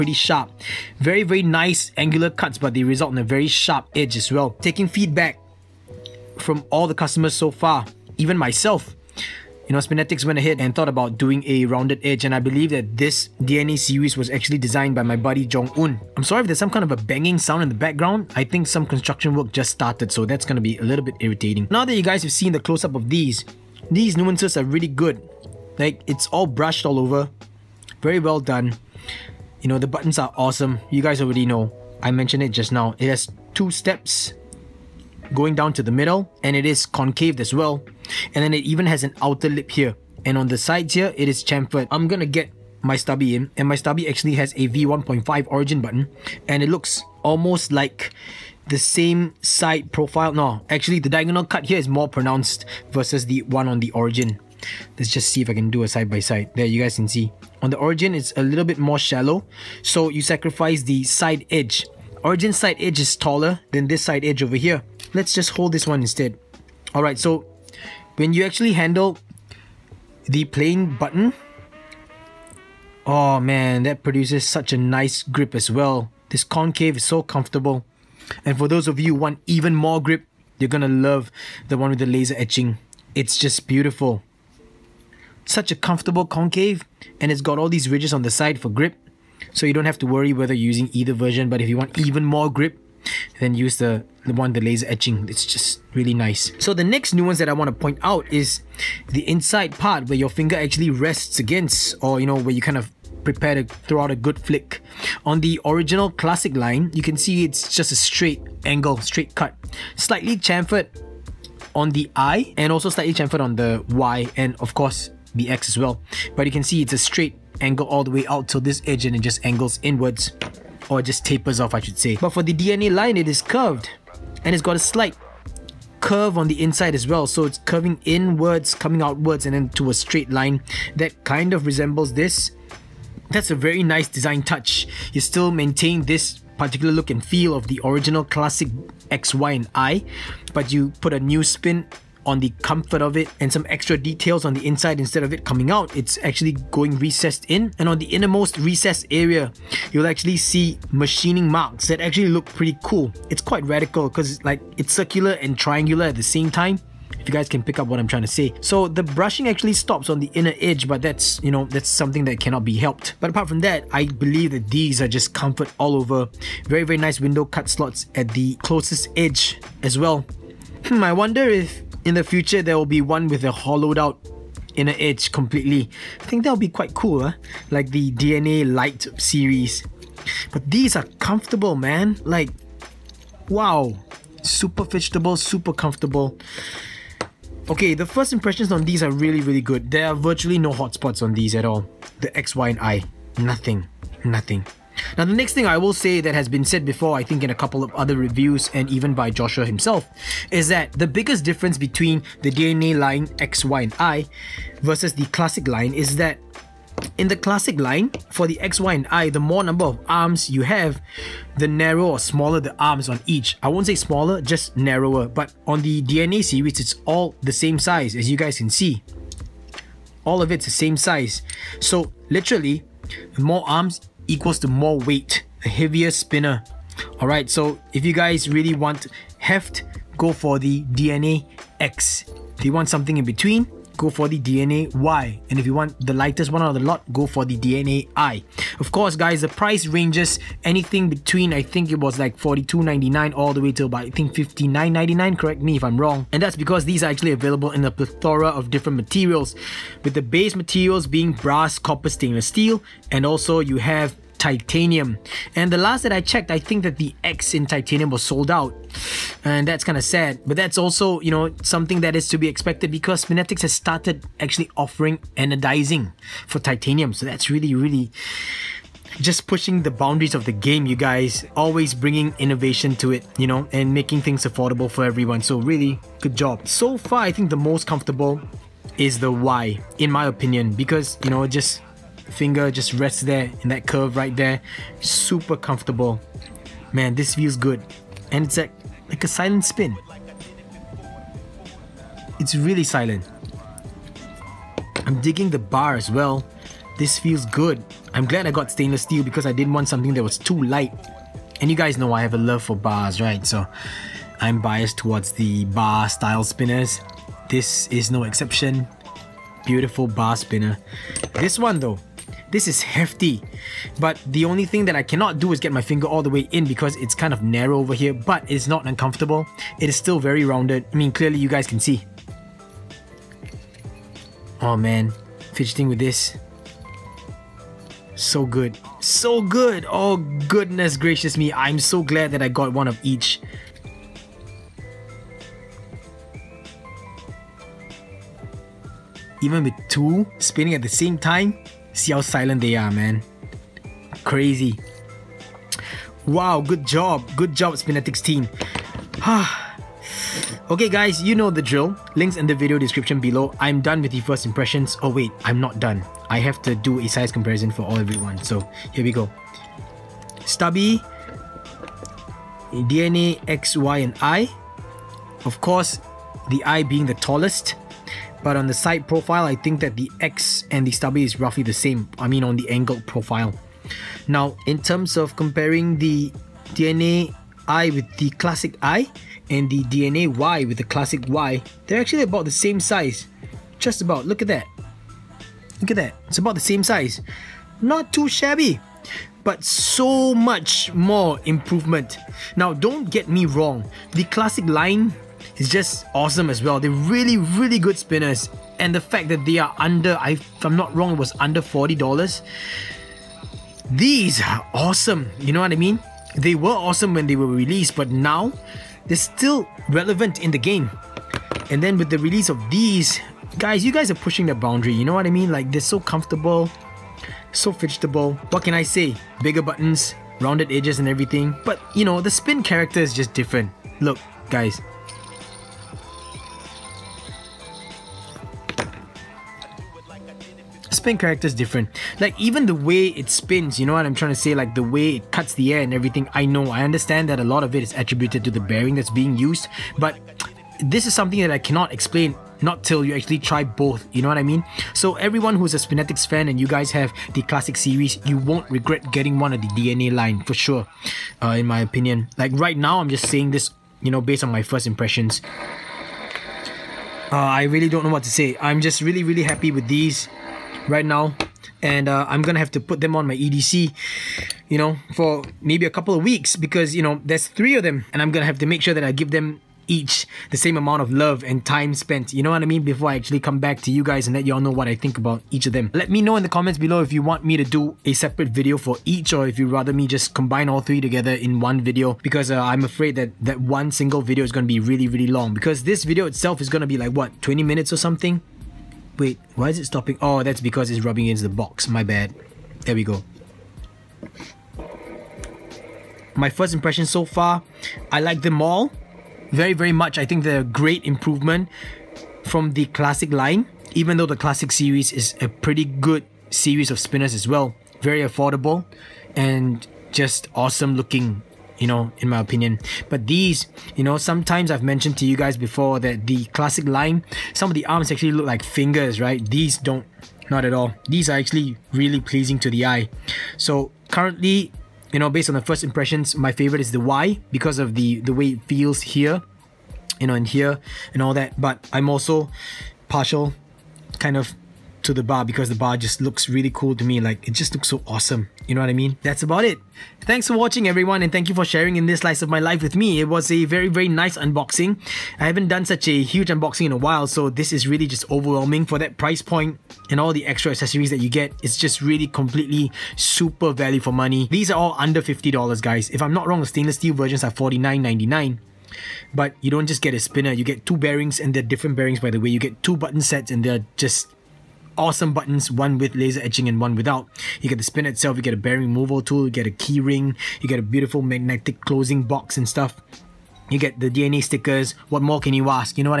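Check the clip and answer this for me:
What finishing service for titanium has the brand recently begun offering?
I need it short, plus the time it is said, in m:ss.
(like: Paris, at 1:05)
anodizing, at 4:25.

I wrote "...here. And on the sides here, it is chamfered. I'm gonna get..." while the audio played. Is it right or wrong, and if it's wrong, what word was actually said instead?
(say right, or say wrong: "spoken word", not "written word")
right.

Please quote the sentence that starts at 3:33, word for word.
I won't say smaller, just narrower.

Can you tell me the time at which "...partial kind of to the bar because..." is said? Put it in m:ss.
8:53.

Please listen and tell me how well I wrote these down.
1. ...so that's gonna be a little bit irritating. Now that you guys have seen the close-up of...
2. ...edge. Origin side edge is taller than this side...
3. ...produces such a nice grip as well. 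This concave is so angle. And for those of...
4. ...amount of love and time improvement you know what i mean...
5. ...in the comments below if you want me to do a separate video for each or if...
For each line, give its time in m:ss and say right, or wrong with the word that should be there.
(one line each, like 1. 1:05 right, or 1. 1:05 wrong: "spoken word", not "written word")
1. 0:20 right
2. 1:01 right
3. 1:14 wrong: "comfortable", not "angle"
4. 7:50 wrong: "spent", not "improvement"
5. 7:56 right.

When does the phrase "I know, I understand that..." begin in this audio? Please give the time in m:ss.
7:16.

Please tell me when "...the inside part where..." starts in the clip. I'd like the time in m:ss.
1:39.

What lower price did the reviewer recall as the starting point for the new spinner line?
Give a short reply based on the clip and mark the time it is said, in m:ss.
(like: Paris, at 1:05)
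$42.99, at 4:02.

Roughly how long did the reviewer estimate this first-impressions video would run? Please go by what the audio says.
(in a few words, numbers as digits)
20 minutes.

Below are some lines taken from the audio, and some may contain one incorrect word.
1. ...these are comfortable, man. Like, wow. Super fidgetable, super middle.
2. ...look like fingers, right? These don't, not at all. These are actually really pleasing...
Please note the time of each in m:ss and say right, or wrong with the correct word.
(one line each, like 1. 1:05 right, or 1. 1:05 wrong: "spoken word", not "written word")
1. 3:00 wrong: "comfortable", not "middle"
2. 8:38 right.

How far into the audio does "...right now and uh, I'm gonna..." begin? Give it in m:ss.
7:40.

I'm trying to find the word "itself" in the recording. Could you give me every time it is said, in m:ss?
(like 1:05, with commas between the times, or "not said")
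8:06, 9:28.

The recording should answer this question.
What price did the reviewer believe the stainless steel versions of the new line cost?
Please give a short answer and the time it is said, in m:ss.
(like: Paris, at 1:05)
$49.99, at 9:17.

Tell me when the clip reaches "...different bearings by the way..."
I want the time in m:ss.
9:21.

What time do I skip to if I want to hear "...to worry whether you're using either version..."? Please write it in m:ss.
1:29.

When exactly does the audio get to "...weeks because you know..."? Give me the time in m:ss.
7:46.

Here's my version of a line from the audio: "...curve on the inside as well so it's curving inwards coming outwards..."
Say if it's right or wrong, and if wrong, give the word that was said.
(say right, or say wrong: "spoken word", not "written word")
right.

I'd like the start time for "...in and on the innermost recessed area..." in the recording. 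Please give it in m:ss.
2:27.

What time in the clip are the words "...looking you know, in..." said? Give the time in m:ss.
8:30.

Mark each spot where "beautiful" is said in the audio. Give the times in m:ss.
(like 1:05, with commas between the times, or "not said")
1:23, 5:09, 9:30.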